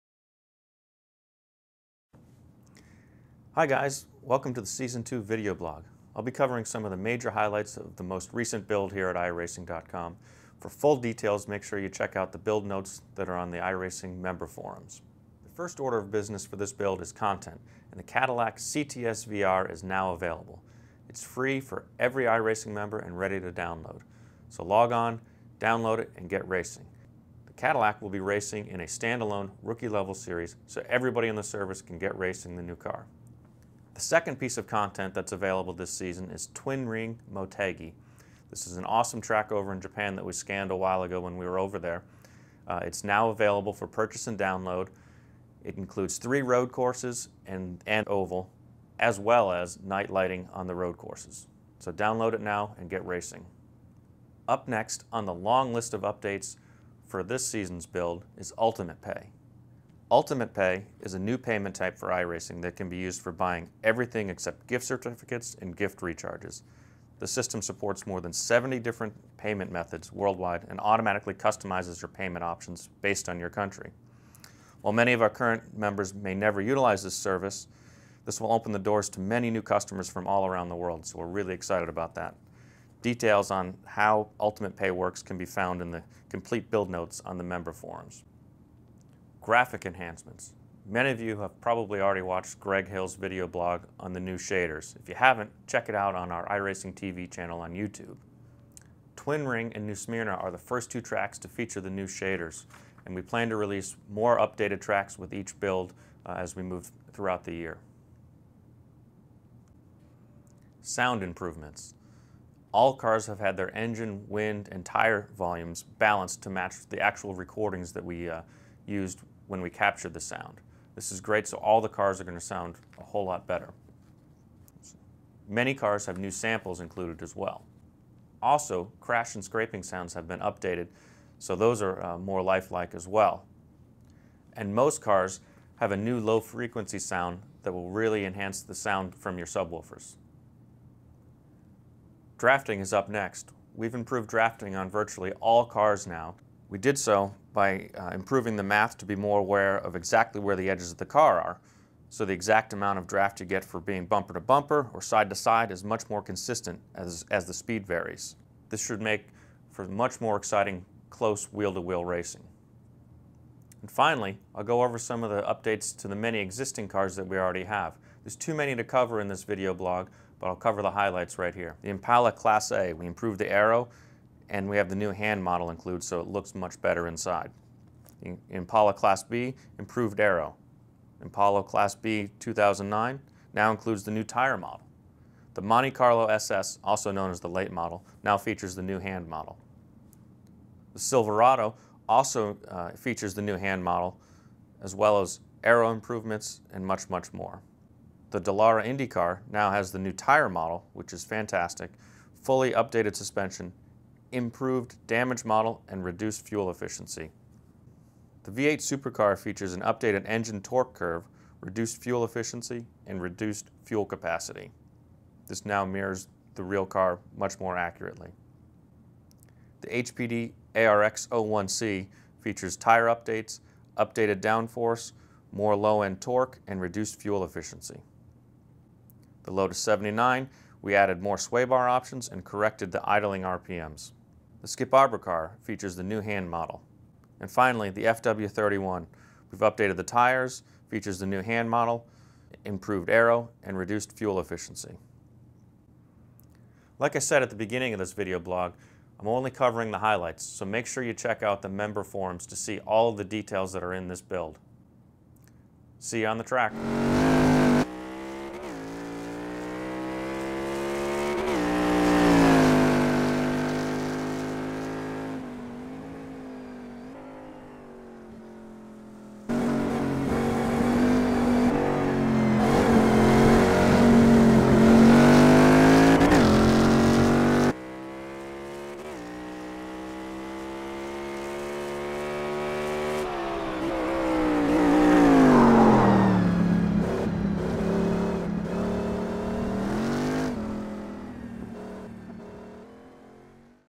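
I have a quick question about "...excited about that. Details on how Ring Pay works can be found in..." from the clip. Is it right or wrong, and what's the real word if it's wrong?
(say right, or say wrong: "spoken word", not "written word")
wrong: "Ultimate", not "Ring".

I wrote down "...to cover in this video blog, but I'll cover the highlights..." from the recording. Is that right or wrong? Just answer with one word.
right.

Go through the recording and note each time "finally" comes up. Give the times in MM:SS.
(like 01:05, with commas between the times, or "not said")
02:43, 03:57.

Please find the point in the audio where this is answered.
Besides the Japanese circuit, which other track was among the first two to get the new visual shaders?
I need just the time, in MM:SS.
01:39.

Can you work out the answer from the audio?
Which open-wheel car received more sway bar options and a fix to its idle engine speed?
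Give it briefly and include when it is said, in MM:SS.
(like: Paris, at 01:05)
Lotus 79, at 03:49.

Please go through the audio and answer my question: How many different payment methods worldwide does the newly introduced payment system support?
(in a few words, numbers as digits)
more than 70.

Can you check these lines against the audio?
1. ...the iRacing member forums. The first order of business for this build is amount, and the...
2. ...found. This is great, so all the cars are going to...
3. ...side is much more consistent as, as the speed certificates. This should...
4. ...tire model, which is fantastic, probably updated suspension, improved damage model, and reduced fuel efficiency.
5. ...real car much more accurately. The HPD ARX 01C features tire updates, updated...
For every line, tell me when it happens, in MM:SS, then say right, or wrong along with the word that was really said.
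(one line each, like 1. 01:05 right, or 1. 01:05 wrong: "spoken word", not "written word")
1. 00:13 wrong: "content", not "amount"
2. 02:00 wrong: "sound", not "found"
3. 02:35 wrong: "varies", not "certificates"
4. 03:20 wrong: "fully", not "probably"
5. 03:36 right.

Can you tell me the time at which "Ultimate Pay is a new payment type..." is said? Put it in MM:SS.
01:00.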